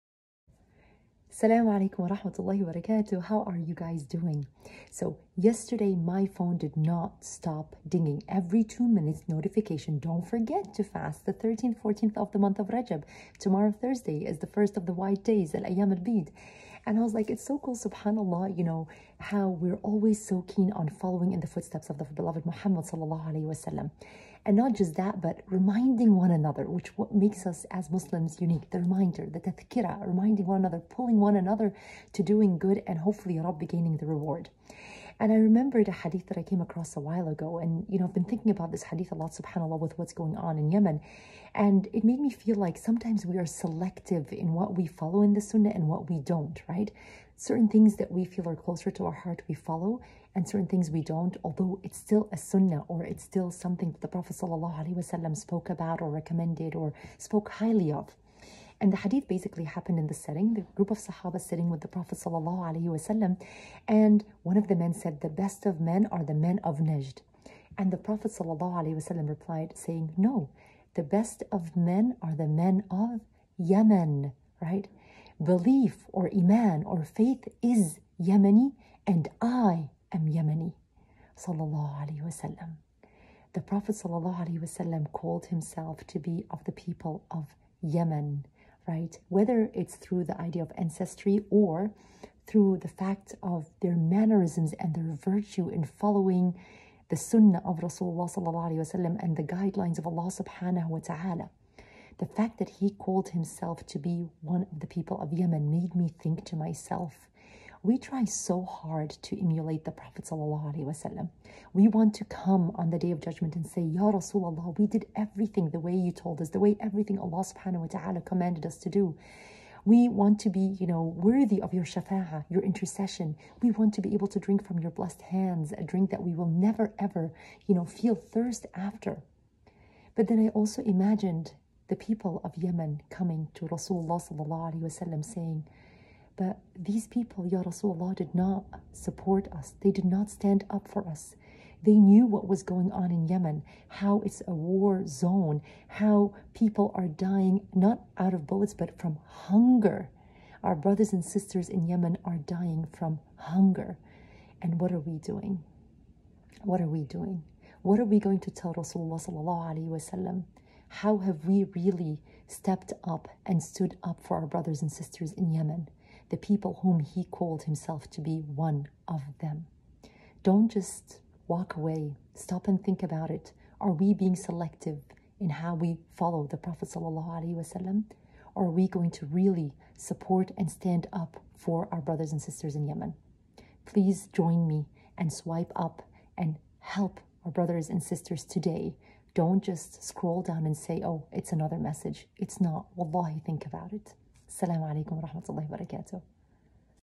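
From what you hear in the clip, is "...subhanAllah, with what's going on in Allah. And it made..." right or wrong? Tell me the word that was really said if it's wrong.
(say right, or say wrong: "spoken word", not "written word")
wrong: "Yemen", not "Allah".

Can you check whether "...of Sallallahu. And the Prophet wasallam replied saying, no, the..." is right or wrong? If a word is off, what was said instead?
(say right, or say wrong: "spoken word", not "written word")
wrong: "Najd", not "Sallallahu".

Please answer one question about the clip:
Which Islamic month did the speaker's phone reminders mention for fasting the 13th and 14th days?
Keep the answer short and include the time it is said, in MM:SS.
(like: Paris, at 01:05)
Rajab, at 00:12.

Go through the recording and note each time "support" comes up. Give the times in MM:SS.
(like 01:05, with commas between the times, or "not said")
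02:18, 02:59.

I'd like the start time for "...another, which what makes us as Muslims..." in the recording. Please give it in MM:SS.
00:26.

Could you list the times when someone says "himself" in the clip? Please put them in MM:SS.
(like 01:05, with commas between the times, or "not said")
01:25, 01:43, 02:47.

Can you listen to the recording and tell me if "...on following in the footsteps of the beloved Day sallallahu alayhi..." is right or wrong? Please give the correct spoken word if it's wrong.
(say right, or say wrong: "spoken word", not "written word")
wrong: "Muhammad", not "Day".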